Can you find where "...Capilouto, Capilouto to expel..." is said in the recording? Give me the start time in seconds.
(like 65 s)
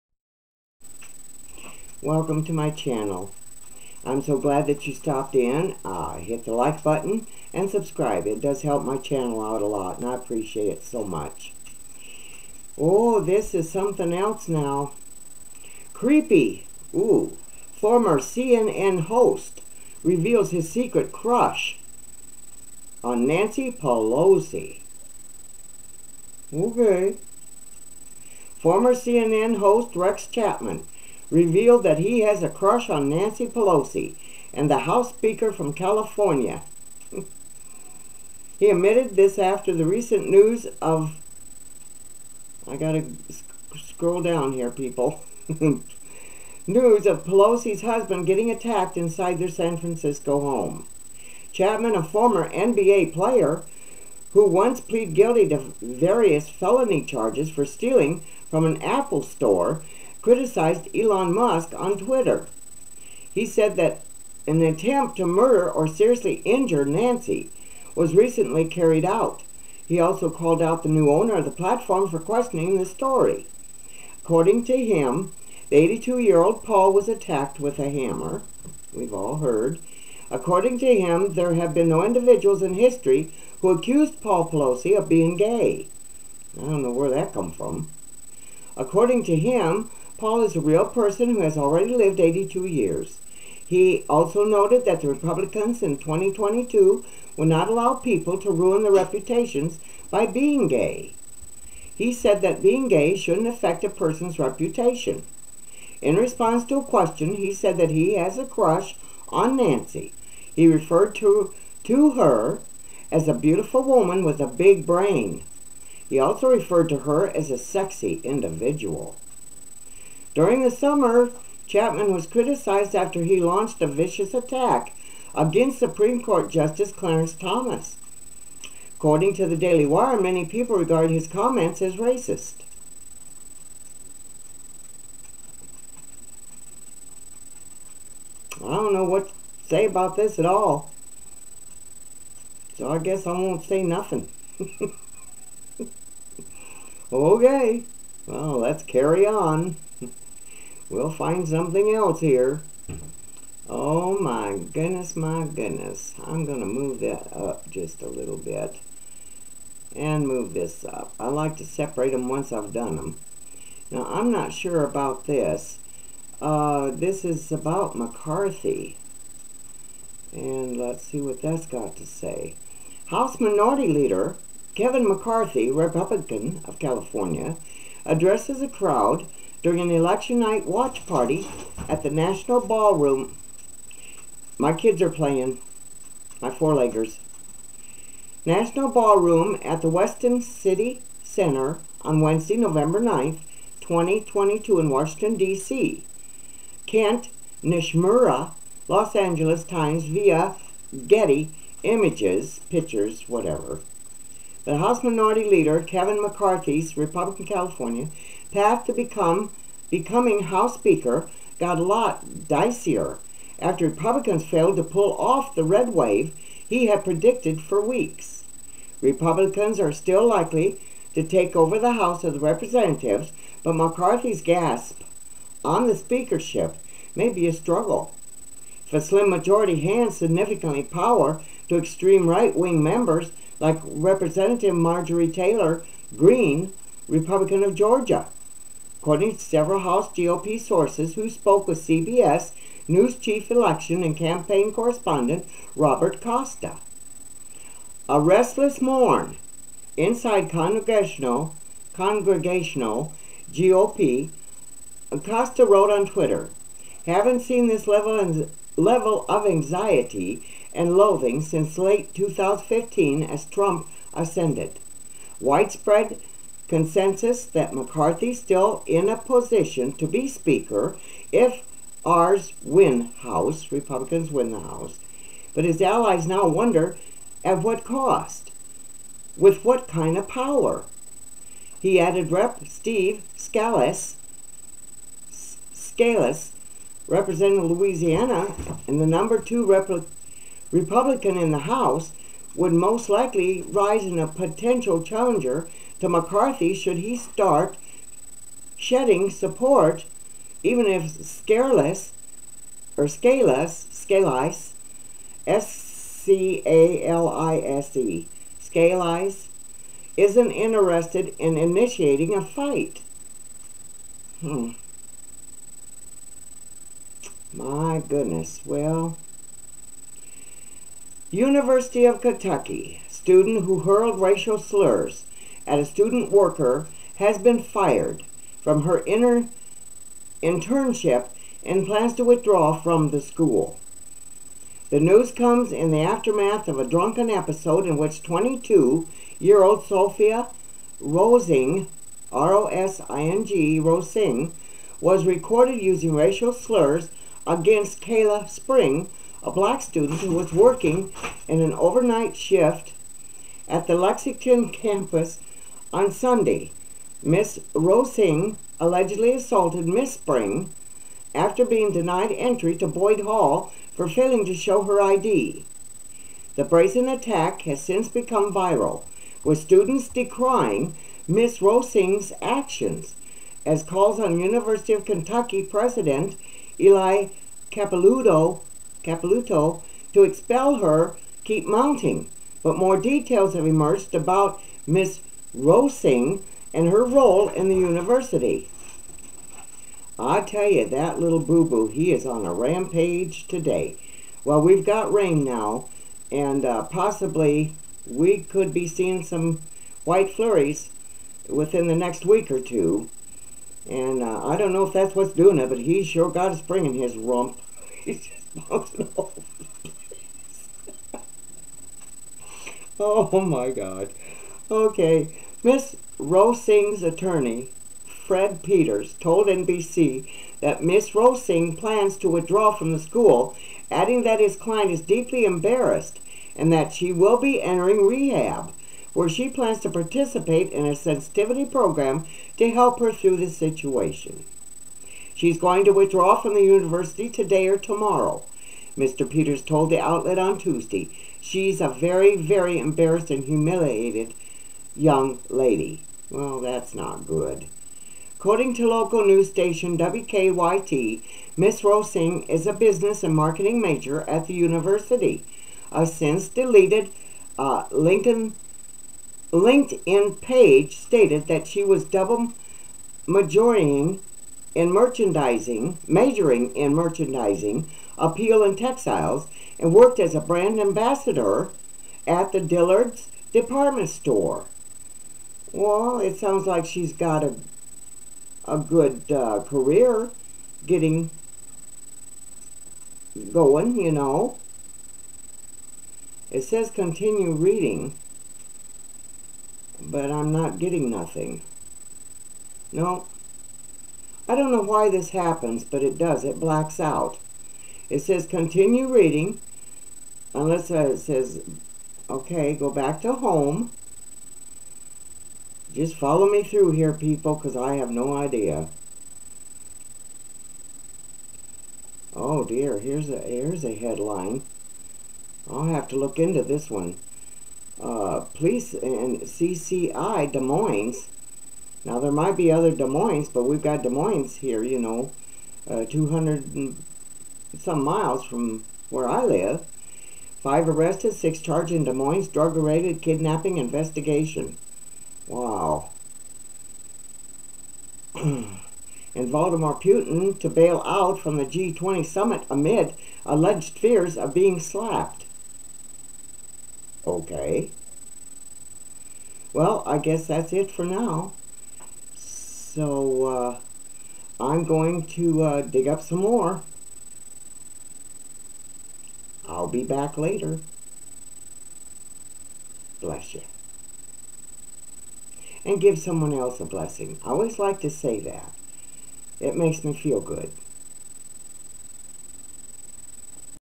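377 s.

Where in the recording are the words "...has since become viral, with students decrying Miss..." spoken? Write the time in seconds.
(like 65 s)
367 s.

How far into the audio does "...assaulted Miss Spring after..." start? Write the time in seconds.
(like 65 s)
359 s.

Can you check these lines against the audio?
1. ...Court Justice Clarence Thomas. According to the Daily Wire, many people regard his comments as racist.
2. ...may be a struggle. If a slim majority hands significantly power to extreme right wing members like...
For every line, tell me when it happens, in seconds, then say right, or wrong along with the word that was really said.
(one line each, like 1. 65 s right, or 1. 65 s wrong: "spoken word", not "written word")
1. 126 s right
2. 227 s right.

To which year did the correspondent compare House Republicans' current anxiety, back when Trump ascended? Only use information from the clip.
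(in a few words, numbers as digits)
2015.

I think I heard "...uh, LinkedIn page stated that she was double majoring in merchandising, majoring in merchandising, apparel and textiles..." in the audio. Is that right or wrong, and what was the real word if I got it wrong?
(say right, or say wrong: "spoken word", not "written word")
right.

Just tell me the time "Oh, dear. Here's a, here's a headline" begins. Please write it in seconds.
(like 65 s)
512 s.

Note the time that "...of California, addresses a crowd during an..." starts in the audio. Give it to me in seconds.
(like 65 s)
176 s.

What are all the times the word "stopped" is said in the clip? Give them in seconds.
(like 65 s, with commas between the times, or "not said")
4 s.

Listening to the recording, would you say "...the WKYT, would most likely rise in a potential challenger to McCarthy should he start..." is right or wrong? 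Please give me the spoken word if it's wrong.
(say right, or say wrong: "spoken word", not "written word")
wrong: "House", not "WKYT".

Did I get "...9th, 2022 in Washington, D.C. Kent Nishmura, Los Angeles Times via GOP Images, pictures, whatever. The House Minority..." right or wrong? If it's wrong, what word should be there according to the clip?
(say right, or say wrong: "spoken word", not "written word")
wrong: "Getty", not "GOP".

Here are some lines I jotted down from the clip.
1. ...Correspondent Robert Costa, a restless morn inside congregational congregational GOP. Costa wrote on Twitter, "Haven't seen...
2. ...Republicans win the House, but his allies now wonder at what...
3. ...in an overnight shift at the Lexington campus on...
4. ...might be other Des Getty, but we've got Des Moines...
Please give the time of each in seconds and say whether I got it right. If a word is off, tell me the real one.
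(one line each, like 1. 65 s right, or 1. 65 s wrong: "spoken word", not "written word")
1. 244 s right
2. 273 s right
3. 351 s right
4. 522 s wrong: "Moines", not "Getty".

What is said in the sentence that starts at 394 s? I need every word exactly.
Well, we've got rain now, and uh, possibly we could be seeing some white flurries within the next week or two.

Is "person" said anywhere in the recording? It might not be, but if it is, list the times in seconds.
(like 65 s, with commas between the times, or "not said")
90 s, 103 s.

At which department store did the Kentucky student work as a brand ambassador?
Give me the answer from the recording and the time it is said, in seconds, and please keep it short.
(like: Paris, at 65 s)
Dillard's, at 472 s.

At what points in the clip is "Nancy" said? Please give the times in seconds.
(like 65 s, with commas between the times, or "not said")
23 s, 33 s, 66 s, 109 s.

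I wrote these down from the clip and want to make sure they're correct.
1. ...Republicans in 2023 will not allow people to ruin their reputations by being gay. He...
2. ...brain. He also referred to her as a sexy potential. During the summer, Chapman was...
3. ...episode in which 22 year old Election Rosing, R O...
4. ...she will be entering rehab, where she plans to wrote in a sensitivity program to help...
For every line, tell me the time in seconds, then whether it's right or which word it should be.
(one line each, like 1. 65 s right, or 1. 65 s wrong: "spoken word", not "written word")
1. 95 s wrong: "2022", not "2023"
2. 114 s wrong: "individual", not "potential"
3. 337 s wrong: "Sophia", not "Election"
4. 426 s wrong: "participate", not "wrote".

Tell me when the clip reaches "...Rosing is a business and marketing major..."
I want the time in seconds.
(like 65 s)
451 s.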